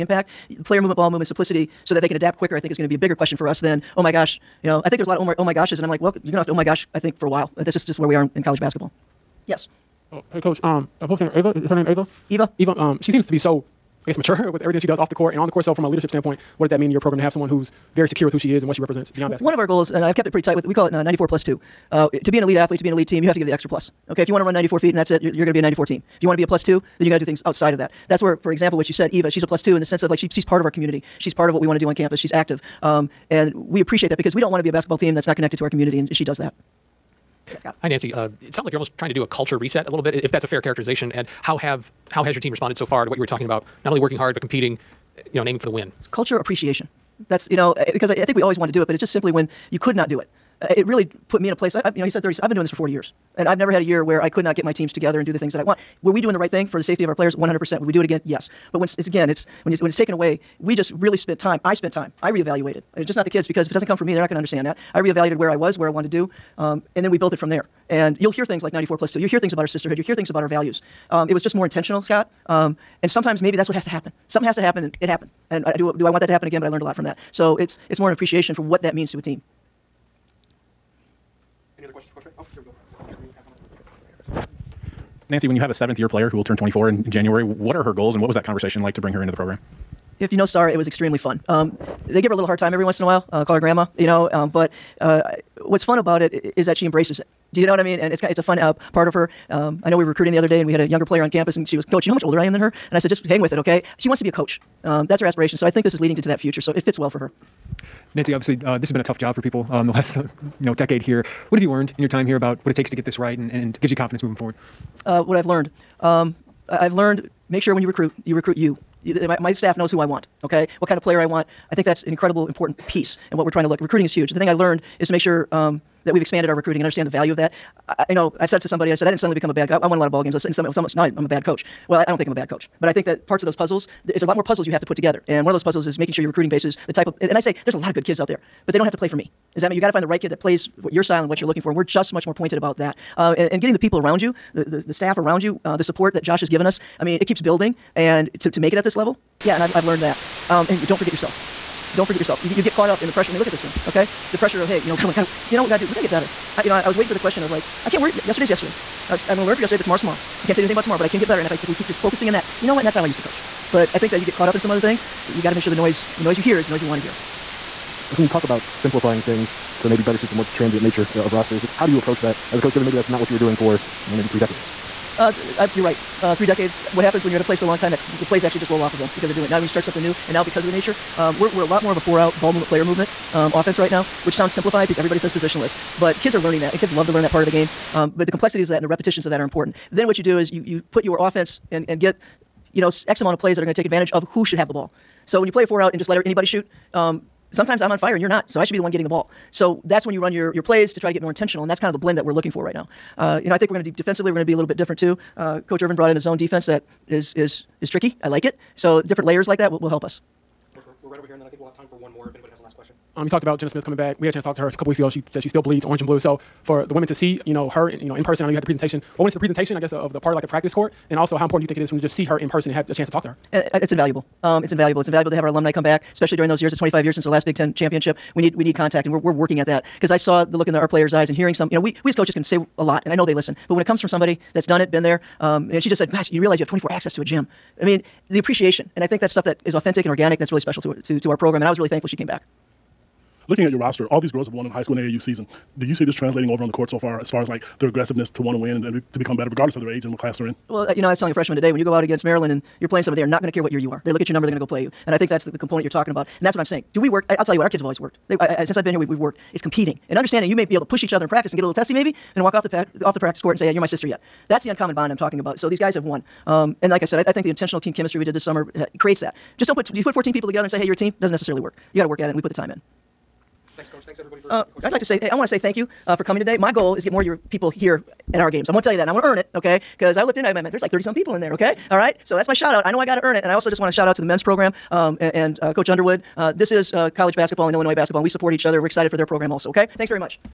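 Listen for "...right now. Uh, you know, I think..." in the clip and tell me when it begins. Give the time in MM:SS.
03:22.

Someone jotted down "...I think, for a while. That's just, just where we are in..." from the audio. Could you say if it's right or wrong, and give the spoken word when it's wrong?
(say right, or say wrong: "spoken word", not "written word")
right.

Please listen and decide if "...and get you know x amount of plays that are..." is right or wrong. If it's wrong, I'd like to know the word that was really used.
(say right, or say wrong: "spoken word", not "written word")
right.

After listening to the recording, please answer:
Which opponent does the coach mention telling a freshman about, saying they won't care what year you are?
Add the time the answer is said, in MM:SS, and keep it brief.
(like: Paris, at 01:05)
Maryland, at 04:12.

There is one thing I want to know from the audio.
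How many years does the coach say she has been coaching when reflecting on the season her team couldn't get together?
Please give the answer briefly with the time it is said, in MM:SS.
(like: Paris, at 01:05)
40, at 00:52.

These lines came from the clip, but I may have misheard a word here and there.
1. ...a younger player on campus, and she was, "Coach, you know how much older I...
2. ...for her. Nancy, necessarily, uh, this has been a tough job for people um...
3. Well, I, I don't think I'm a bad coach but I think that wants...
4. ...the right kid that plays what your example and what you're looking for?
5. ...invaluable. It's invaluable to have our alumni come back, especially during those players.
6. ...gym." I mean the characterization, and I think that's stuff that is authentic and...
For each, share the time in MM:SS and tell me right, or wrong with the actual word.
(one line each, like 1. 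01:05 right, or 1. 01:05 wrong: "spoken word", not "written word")
1. 01:40 right
2. 01:47 wrong: "obviously", not "necessarily"
3. 02:11 wrong: "parts", not "wants"
4. 02:20 wrong: "style", not "example"
5. 03:44 wrong: "years", not "players"
6. 03:57 wrong: "appreciation", not "characterization".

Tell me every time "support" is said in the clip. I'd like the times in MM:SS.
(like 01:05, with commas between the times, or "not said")
02:25, 04:48.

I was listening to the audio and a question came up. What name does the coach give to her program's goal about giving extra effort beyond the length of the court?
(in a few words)
94 plus two.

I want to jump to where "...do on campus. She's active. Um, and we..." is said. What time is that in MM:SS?
00:31.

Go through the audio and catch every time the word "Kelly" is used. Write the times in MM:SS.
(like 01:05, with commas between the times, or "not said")
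not said.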